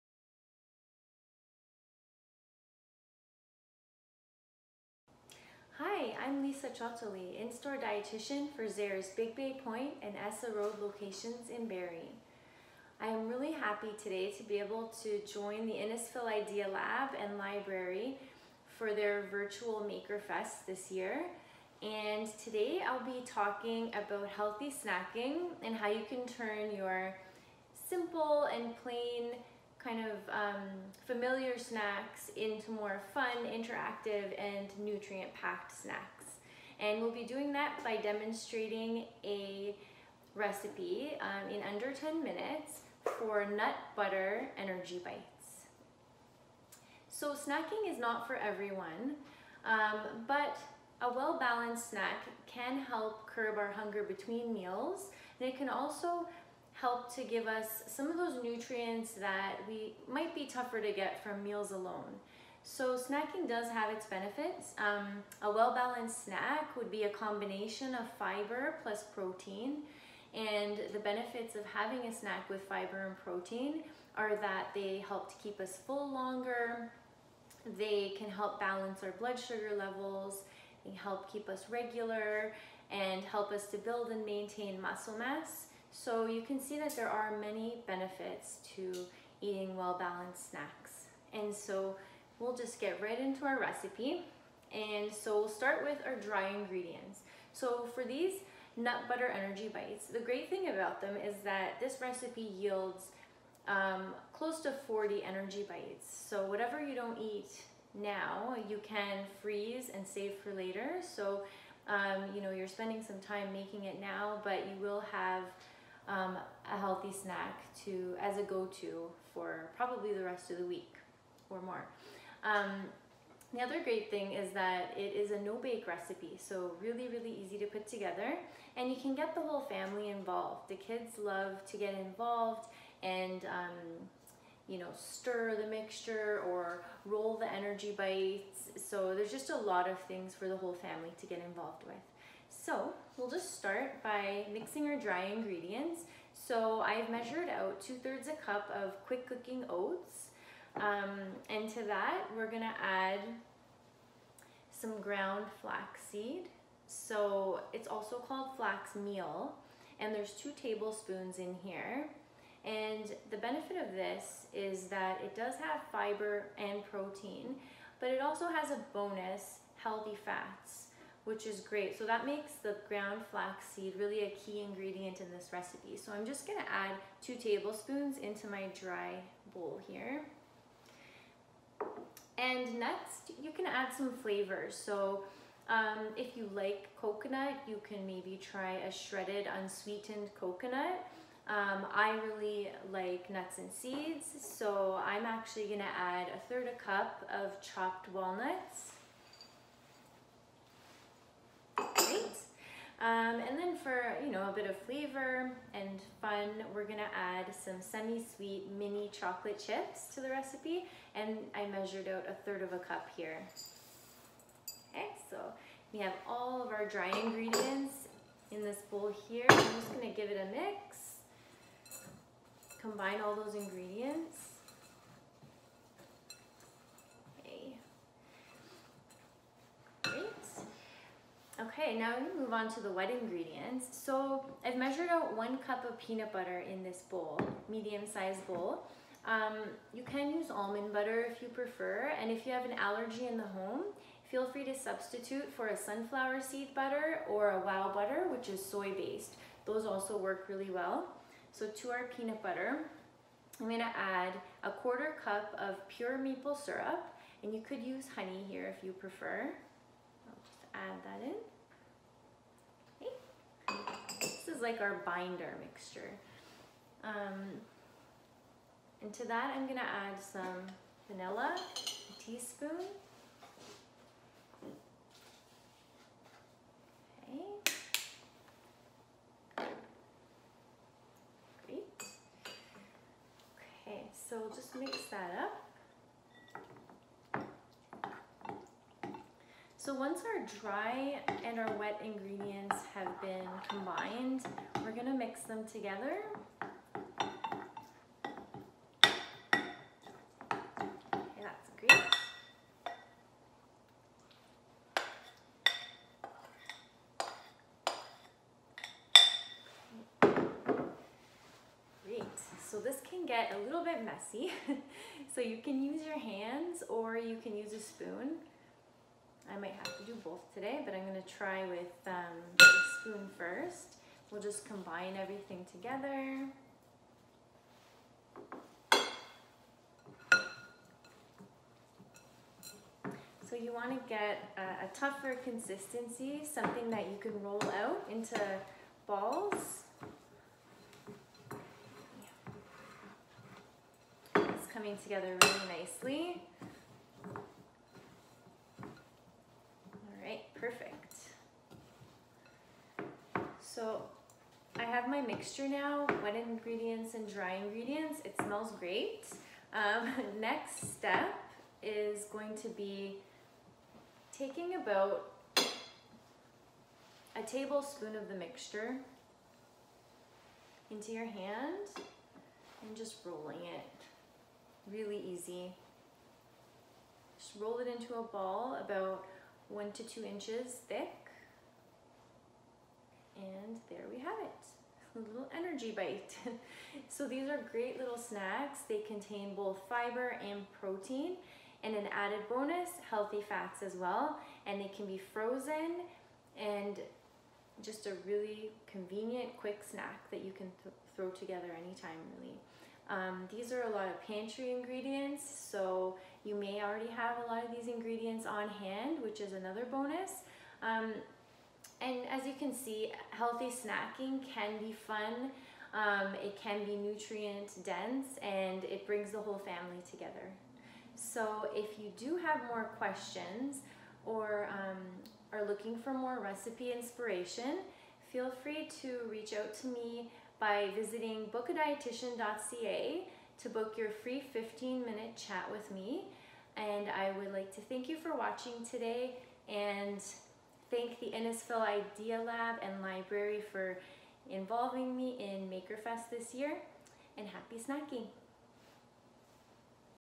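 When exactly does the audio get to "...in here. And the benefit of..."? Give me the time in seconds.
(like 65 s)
161 s.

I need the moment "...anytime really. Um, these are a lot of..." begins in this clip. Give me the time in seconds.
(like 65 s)
401 s.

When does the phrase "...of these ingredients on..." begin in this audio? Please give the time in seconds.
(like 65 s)
407 s.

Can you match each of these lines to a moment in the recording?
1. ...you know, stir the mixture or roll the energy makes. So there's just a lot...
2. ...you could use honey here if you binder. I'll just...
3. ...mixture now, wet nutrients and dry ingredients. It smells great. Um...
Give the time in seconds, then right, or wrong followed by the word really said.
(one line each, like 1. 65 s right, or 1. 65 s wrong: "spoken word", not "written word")
1. 134 s wrong: "bites", not "makes"
2. 257 s wrong: "prefer", not "binder"
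3. 355 s wrong: "ingredients", not "nutrients".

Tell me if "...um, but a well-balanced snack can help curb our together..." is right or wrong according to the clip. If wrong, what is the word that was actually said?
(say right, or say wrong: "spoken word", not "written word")
wrong: "hunger", not "together".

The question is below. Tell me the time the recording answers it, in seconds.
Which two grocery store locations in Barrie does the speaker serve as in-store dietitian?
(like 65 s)
9 s.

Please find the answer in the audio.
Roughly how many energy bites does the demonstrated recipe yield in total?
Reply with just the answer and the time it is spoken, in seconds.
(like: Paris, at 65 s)
40, at 104 s.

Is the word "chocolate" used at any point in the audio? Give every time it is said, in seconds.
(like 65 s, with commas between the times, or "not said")
209 s.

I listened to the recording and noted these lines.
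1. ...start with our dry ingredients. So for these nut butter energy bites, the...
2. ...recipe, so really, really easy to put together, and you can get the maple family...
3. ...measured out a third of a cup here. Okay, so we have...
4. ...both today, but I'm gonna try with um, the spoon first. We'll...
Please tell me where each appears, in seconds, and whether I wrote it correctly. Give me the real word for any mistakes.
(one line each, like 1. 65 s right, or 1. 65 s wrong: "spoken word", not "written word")
1. 95 s right
2. 125 s wrong: "whole", not "maple"
3. 211 s right
4. 320 s right.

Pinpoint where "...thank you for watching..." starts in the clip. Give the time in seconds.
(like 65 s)
437 s.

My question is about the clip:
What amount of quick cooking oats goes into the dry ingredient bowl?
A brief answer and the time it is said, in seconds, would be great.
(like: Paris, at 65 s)
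2/3 cup, at 147 s.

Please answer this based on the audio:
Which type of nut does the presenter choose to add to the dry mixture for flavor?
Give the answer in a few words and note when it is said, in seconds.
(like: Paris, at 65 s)
walnuts, at 197 s.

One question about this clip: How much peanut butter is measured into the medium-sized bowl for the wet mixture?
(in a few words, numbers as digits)
1 cup.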